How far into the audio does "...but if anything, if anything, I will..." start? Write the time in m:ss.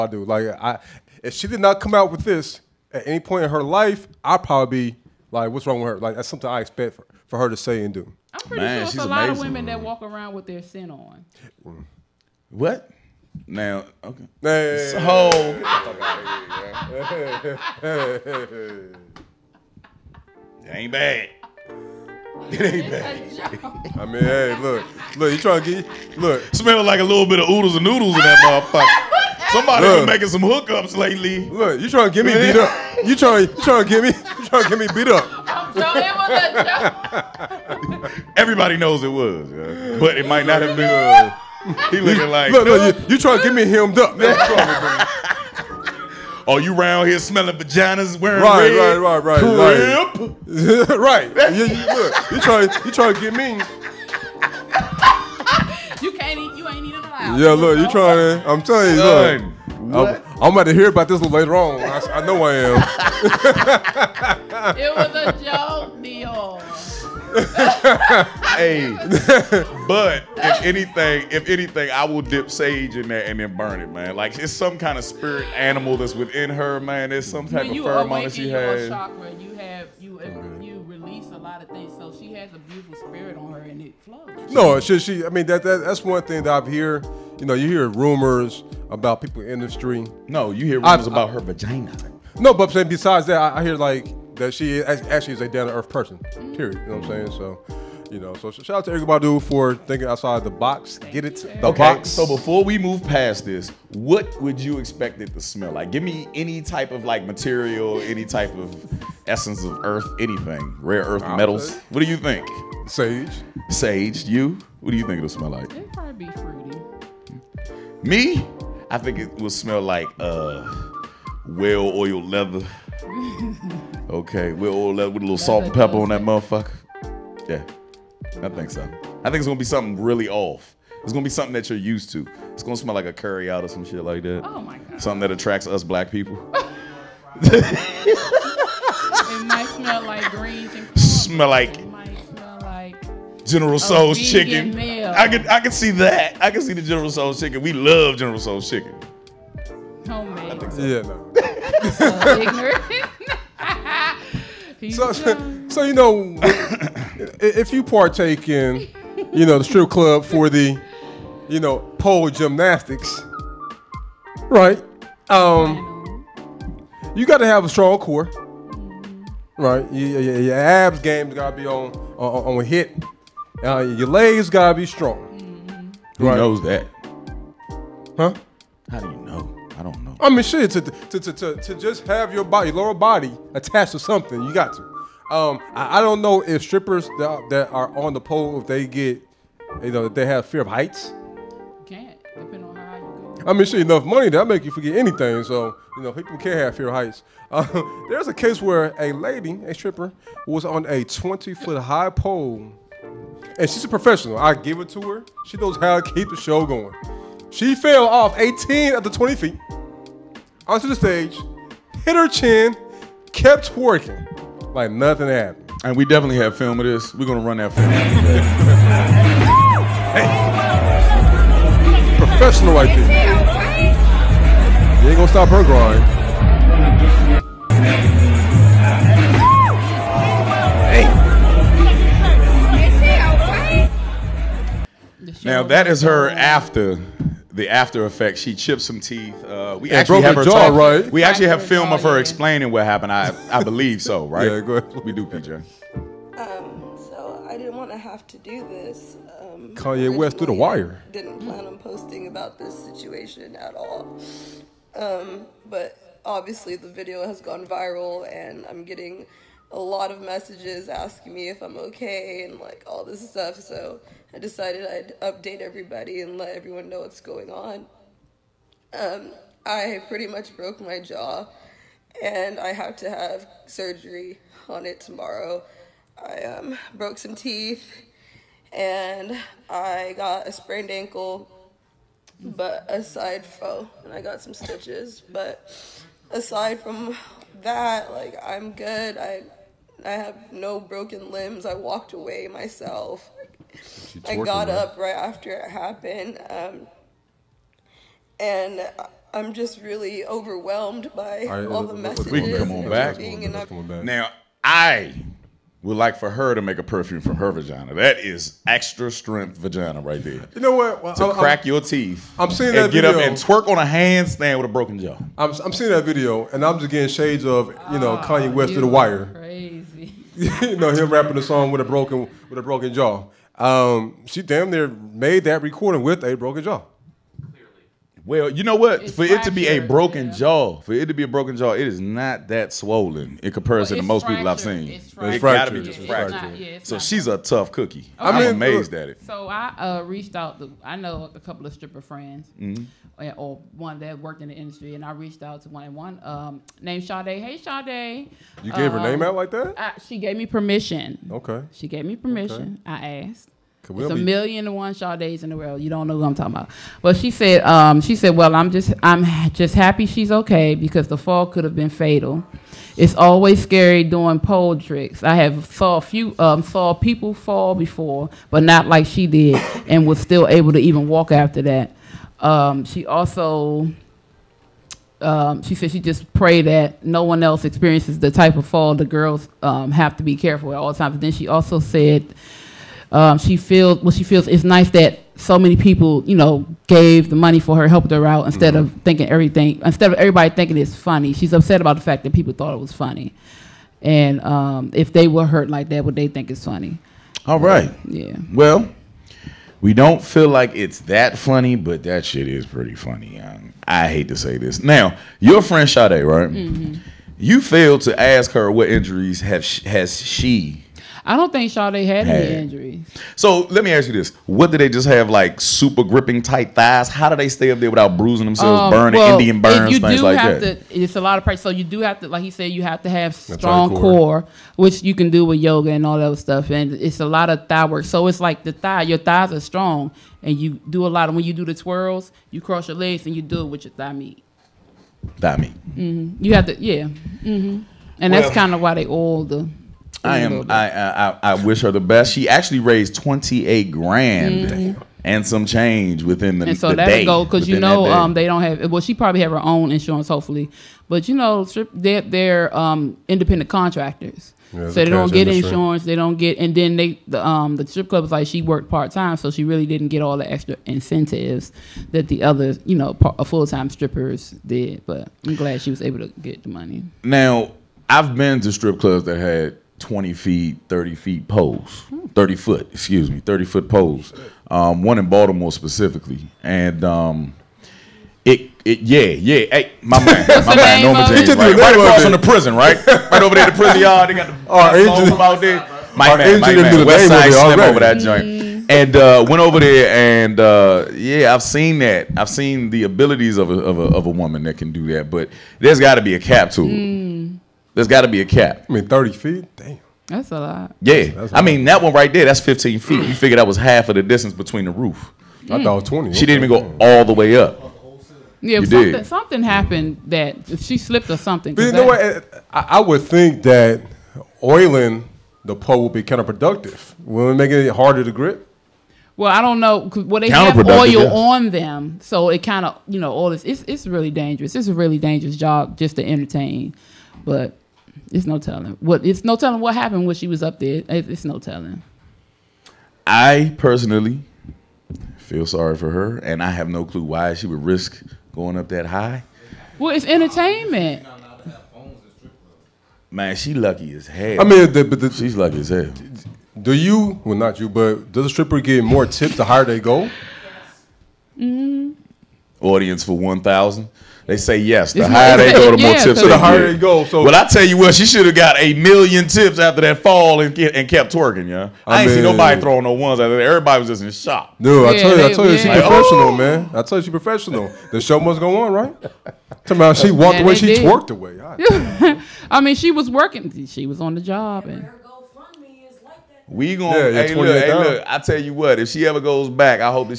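1:09.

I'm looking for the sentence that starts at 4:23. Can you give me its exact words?
So I decided I'd update everybody and let everyone know what's going on.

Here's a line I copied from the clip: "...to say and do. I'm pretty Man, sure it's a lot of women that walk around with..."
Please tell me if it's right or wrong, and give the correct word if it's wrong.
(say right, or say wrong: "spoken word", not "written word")
right.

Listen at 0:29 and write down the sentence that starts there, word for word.
Somebody look, been making some hookups lately.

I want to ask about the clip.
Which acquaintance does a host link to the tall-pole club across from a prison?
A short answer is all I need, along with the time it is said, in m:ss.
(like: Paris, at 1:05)
West Side Slim, at 8:07.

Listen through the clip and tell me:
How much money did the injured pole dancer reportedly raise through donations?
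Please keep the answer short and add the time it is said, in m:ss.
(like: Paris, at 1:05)
$28,000, at 7:23.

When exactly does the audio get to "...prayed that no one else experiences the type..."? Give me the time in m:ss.
6:16.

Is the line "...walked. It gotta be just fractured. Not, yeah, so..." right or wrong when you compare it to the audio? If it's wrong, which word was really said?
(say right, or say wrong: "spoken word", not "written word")
wrong: "fractured", not "walked".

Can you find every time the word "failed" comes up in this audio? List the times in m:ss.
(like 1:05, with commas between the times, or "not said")
6:47.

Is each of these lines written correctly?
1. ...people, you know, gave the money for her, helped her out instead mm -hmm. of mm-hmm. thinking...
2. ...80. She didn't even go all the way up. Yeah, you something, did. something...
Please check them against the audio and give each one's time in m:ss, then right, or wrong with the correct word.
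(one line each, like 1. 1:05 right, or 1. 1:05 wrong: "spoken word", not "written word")
1. 6:25 right
2. 8:26 wrong: "20", not "80".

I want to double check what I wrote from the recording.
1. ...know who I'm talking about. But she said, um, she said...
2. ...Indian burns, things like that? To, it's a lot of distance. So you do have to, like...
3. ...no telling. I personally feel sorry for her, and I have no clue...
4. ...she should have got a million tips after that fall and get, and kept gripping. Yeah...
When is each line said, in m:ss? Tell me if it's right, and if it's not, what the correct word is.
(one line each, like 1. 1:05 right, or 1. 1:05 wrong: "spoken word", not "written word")
1. 5:56 right
2. 6:59 wrong: "practice", not "distance"
3. 8:51 right
4. 9:18 wrong: "twerking", not "gripping".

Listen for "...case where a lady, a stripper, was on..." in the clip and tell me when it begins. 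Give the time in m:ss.
3:18.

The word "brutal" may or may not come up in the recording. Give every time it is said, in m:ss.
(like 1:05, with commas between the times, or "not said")
not said.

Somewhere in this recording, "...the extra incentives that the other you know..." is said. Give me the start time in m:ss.
7:40.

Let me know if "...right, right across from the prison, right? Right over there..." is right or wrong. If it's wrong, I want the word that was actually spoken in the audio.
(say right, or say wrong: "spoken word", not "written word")
right.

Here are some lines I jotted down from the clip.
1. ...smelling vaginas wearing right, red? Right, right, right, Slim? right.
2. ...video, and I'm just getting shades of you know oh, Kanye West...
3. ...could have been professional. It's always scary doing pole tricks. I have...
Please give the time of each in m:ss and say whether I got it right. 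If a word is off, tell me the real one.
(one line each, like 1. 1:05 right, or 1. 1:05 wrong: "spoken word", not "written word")
1. 0:47 wrong: "Crip", not "Slim"
2. 5:16 right
3. 6:01 wrong: "fatal", not "professional".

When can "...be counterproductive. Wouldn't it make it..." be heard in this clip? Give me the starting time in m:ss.
8:36.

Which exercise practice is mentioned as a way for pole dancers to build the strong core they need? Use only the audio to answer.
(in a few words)
Yoga.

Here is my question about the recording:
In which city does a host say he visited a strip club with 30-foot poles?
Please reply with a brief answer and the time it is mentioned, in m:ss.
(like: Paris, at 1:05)
Baltimore, at 7:55.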